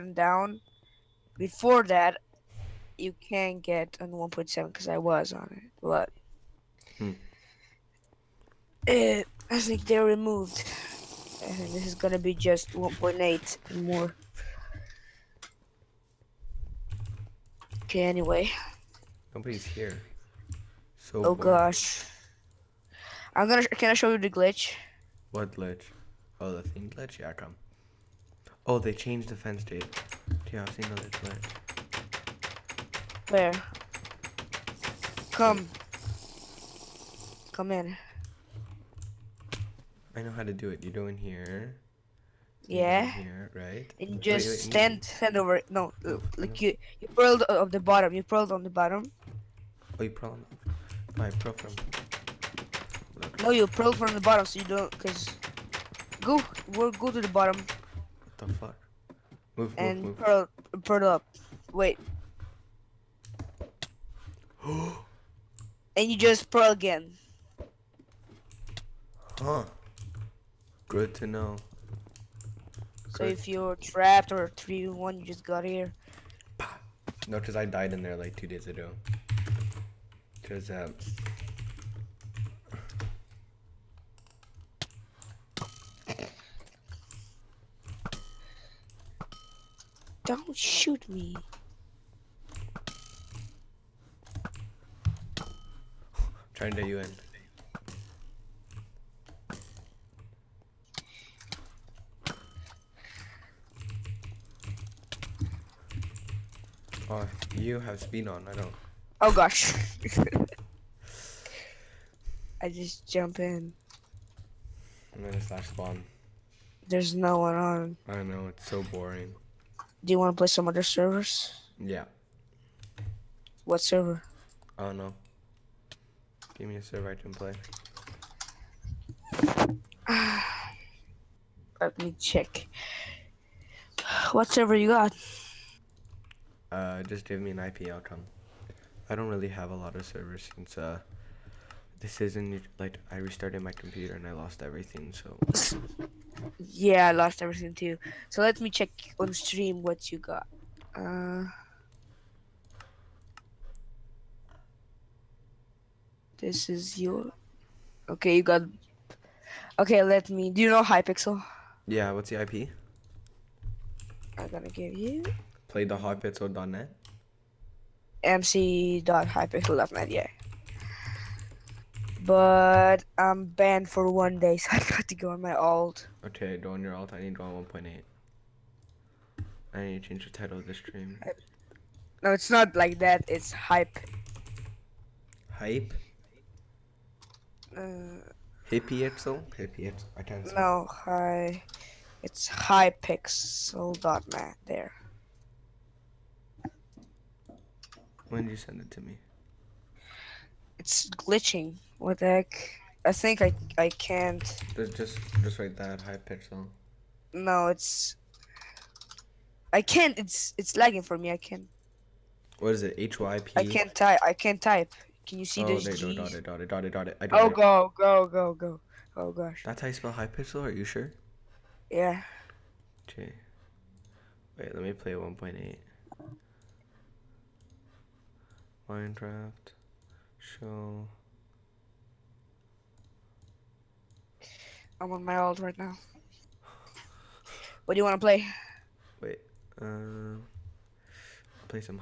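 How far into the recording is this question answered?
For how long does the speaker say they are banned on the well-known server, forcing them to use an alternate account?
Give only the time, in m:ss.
2:54.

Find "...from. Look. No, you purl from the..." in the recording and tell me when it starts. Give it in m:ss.
0:51.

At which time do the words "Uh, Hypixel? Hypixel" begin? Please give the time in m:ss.
3:07.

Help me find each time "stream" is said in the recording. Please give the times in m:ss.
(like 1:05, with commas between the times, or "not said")
2:29, 3:00.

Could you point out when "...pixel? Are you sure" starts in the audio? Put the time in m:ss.
3:40.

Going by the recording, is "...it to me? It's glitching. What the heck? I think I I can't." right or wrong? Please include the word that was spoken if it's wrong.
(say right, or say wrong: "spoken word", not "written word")
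right.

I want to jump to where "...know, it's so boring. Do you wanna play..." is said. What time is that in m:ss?
1:58.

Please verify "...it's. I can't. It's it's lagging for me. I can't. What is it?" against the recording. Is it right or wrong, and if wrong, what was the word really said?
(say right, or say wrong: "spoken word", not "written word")
right.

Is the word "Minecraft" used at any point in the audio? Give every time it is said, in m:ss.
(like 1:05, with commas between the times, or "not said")
3:48.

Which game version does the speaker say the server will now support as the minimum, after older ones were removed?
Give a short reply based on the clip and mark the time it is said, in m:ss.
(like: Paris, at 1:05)
1.8, at 0:12.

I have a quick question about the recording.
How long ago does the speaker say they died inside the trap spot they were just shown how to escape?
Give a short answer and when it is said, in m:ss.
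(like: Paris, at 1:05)
Two days ago, at 1:18.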